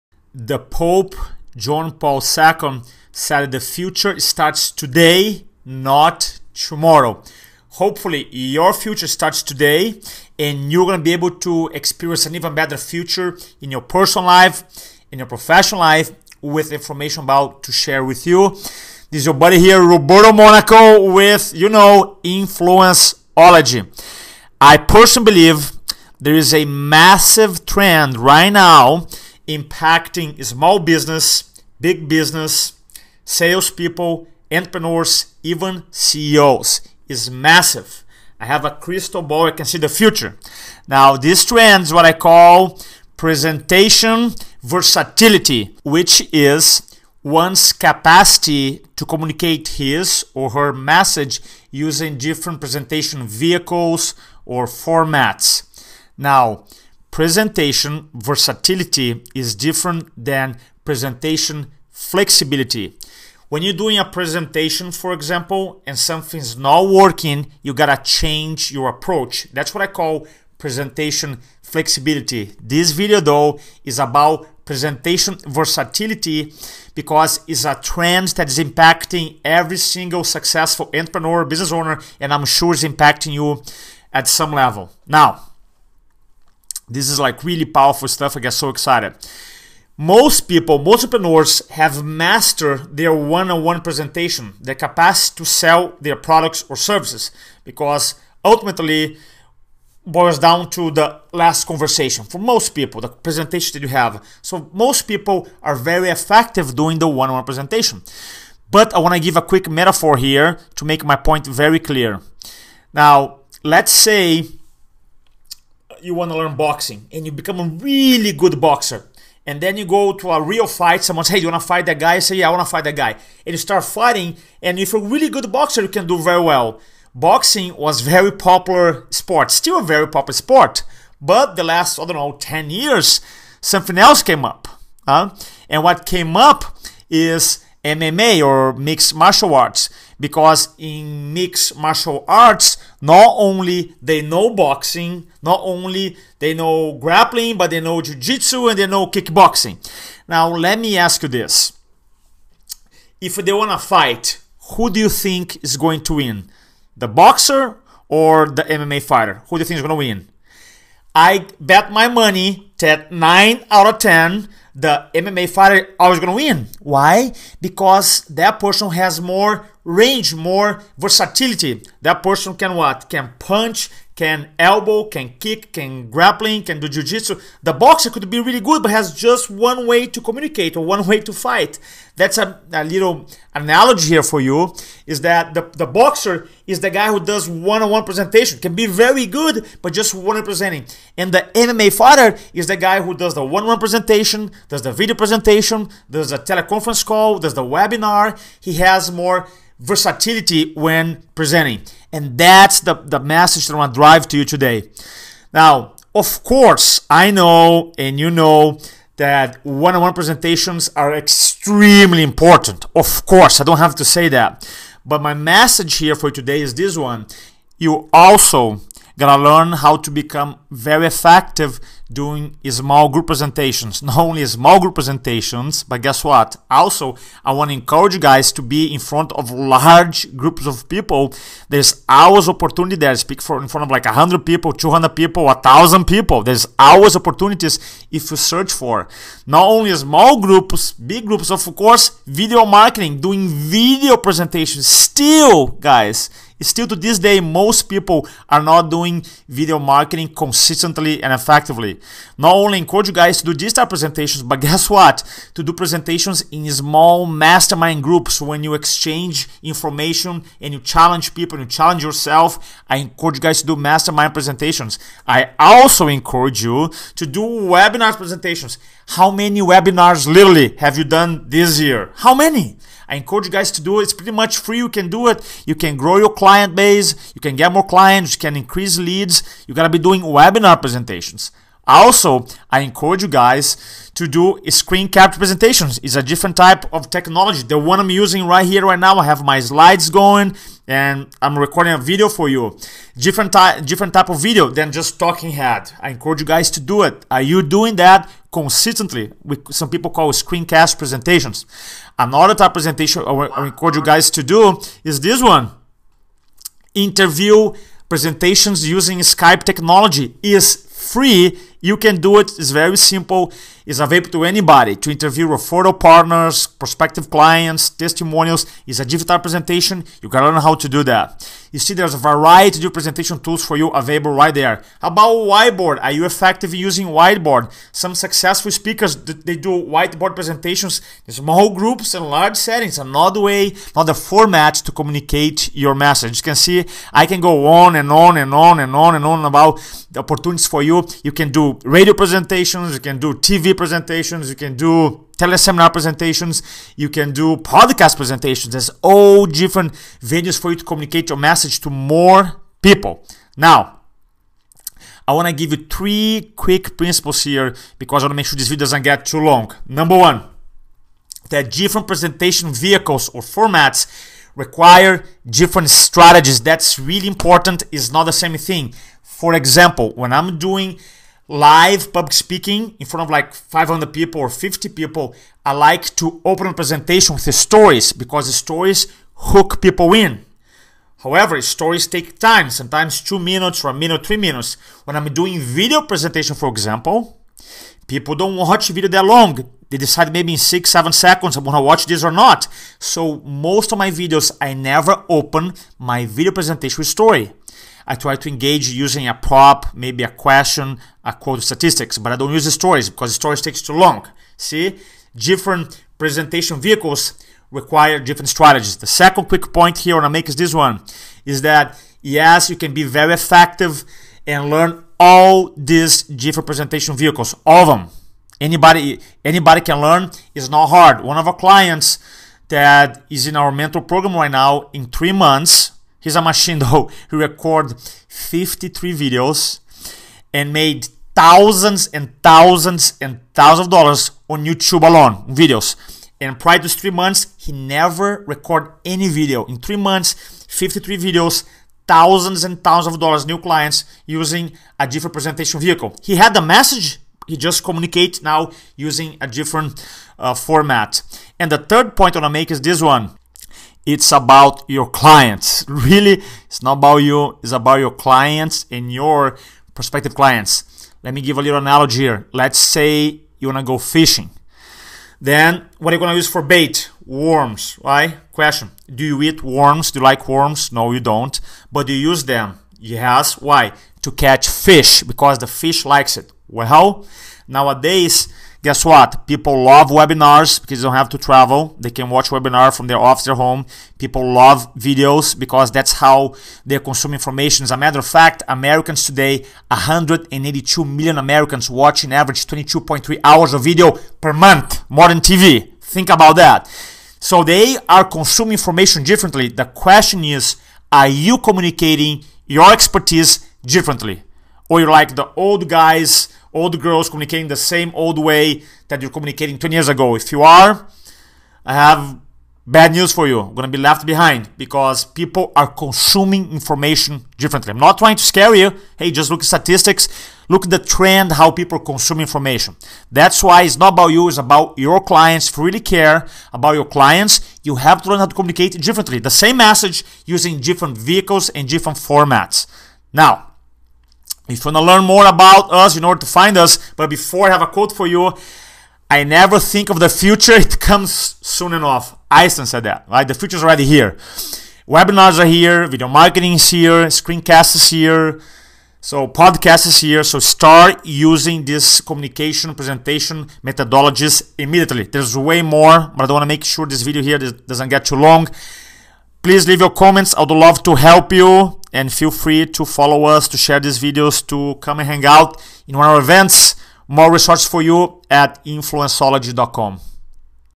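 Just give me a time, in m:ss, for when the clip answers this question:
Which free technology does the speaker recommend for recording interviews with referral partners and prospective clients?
5:09.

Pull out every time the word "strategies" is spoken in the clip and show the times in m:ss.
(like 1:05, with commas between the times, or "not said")
6:05, 6:48.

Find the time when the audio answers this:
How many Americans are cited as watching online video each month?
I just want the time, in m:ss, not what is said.
8:09.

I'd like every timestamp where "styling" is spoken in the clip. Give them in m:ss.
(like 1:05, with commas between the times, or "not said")
not said.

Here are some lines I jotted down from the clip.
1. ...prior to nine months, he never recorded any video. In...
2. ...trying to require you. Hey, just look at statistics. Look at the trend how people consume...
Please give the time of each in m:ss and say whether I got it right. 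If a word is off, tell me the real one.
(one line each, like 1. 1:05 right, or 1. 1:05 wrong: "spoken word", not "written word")
1. 7:16 wrong: "three", not "nine"
2. 8:38 wrong: "scare", not "require".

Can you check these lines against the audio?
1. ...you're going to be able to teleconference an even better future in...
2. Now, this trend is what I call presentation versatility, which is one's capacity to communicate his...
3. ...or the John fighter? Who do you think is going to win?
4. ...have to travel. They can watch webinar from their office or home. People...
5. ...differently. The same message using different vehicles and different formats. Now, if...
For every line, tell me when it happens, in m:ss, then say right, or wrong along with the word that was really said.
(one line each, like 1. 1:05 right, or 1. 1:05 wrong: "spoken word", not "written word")
1. 0:10 wrong: "experience", not "teleconference"
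2. 0:40 right
3. 2:38 wrong: "MMA", not "John"
4. 8:01 right
5. 8:49 right.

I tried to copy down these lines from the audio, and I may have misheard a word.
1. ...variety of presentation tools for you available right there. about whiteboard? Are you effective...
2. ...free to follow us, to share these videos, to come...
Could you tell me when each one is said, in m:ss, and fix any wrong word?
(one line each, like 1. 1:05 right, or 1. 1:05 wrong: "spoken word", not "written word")
1. 5:22 right
2. 9:22 right.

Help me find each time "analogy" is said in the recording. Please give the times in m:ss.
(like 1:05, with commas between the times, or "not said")
3:03, 7:41.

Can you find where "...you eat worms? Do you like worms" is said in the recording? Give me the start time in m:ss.
7:49.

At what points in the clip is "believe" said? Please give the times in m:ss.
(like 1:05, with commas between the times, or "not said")
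0:25.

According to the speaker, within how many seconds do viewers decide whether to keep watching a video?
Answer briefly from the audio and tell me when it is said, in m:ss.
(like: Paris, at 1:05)
6 or 7 seconds, at 6:30.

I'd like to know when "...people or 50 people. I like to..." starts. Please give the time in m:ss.
6:14.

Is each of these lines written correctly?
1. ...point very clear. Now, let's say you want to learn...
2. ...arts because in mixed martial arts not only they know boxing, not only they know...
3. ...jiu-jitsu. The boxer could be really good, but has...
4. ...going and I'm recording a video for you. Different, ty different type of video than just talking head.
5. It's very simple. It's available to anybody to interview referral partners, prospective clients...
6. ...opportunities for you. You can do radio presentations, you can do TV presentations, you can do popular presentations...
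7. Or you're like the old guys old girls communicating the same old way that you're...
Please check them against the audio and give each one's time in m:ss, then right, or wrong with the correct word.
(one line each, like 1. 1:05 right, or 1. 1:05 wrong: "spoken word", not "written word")
1. 1:51 right
2. 2:19 right
3. 2:56 right
4. 4:50 right
5. 5:12 right
6. 5:40 wrong: "teleseminar", not "popular"
7. 8:24 right.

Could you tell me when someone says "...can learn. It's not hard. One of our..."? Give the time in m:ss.
6:59.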